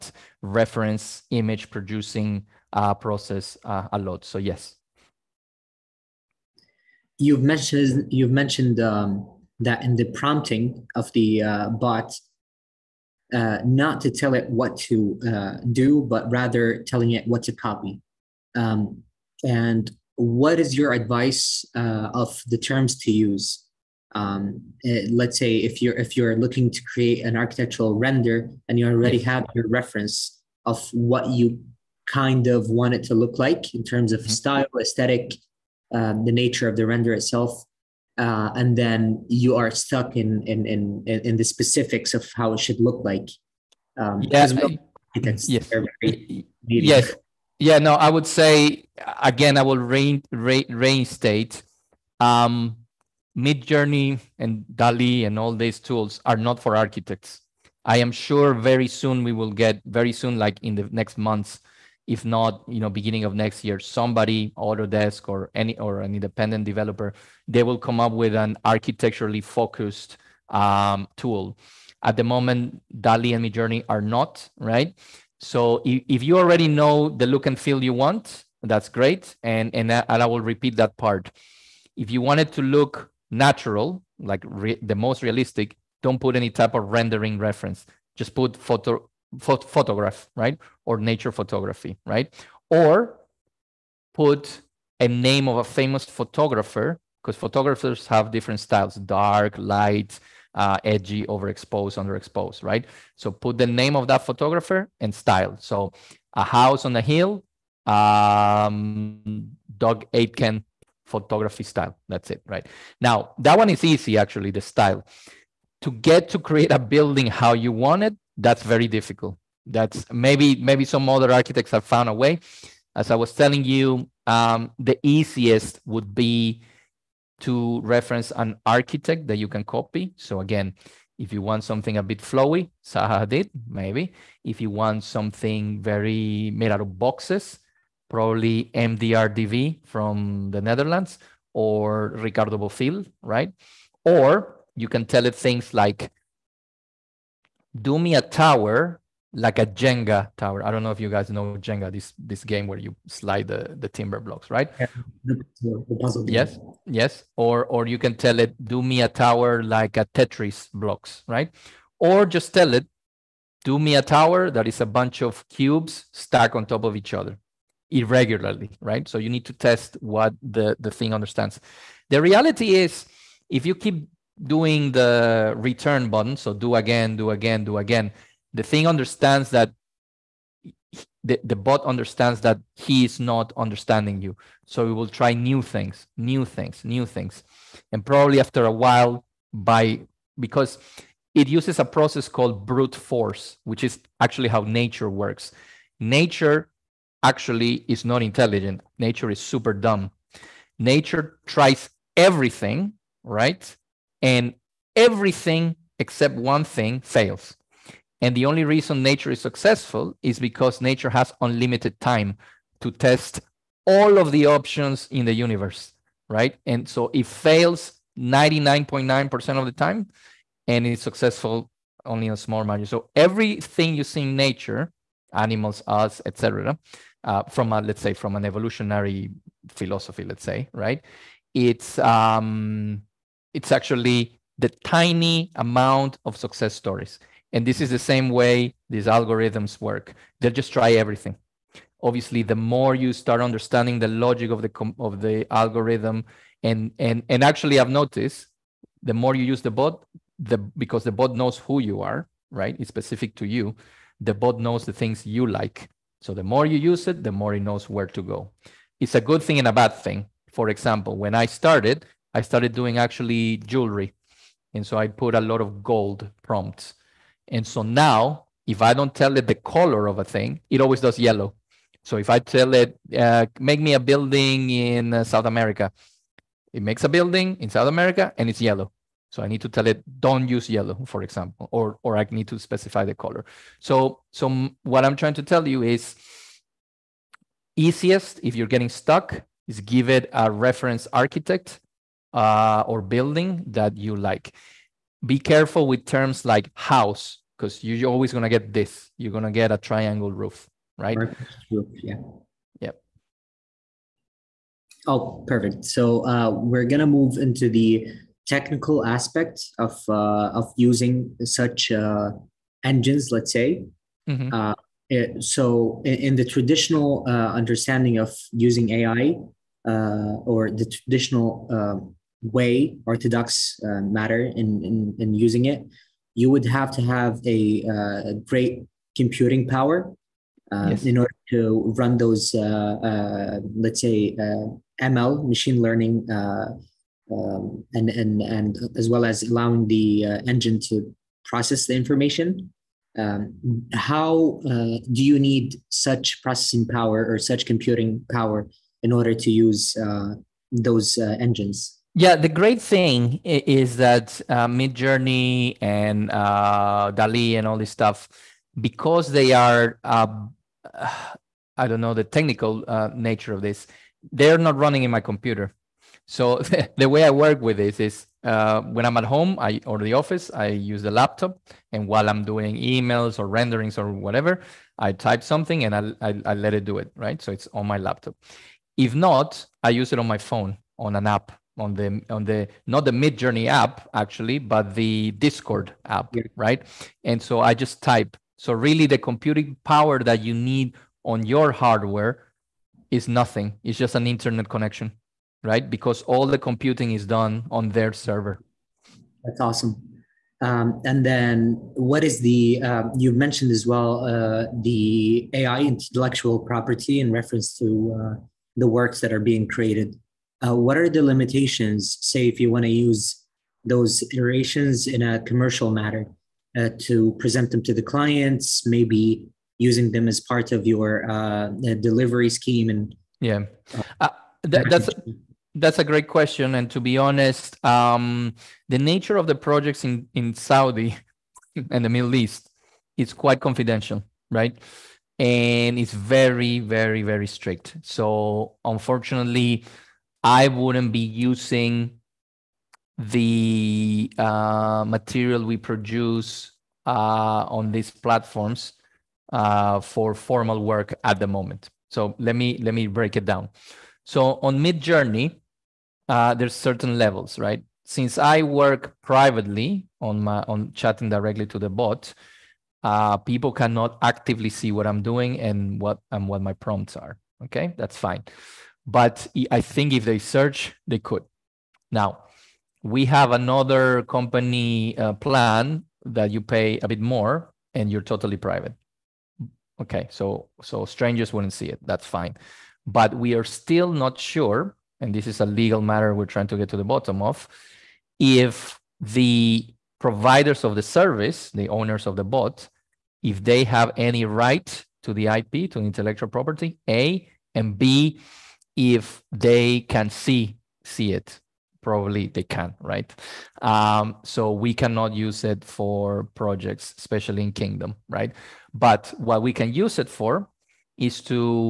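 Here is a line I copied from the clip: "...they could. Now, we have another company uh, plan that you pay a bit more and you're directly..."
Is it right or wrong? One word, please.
wrong.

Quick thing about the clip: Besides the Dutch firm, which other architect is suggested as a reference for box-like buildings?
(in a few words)
Ricardo Bofill.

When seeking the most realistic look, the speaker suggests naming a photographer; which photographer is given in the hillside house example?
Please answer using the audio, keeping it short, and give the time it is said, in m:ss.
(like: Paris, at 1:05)
Doug Aitken, at 1:49.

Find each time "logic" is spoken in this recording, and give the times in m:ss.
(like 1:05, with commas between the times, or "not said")
4:04.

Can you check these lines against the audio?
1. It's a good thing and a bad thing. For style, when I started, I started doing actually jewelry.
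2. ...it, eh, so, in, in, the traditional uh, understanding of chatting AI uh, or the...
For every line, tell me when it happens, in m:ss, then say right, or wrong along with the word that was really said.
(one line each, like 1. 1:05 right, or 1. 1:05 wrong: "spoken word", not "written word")
1. 4:19 wrong: "example", not "style"
2. 5:15 wrong: "using", not "chatting".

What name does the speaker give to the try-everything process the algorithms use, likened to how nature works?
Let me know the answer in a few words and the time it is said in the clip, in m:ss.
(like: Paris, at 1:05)
brute force, at 3:12.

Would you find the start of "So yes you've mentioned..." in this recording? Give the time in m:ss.
0:04.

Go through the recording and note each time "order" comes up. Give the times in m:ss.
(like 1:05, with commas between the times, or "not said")
5:31, 5:49.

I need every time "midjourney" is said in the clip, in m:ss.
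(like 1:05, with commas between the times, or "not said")
0:53, 1:13, 5:54, 6:23, 7:34.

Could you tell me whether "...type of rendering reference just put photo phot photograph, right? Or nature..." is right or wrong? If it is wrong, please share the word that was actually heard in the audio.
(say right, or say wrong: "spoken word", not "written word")
right.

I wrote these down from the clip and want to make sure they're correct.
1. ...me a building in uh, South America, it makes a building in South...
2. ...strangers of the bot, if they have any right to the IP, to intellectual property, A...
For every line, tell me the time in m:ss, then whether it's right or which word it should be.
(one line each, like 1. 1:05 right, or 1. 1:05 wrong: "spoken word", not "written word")
1. 4:33 right
2. 8:11 wrong: "owners", not "strangers".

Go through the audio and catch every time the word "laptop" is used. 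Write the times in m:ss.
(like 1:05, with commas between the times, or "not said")
6:11, 6:17.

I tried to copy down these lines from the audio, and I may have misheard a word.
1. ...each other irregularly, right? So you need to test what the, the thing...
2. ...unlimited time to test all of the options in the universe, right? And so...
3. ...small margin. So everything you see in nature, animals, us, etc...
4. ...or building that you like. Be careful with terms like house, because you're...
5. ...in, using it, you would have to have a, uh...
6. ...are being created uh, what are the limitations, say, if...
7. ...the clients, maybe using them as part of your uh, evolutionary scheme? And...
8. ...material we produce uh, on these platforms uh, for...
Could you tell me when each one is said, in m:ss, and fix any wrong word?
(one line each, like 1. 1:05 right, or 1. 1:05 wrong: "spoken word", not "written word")
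1. 2:46 right
2. 3:31 right
3. 3:42 right
4. 4:52 right
5. 5:25 right
6. 6:49 right
7. 6:57 wrong: "delivery", not "evolutionary"
8. 7:25 right.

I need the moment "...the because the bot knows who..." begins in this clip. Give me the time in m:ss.
4:10.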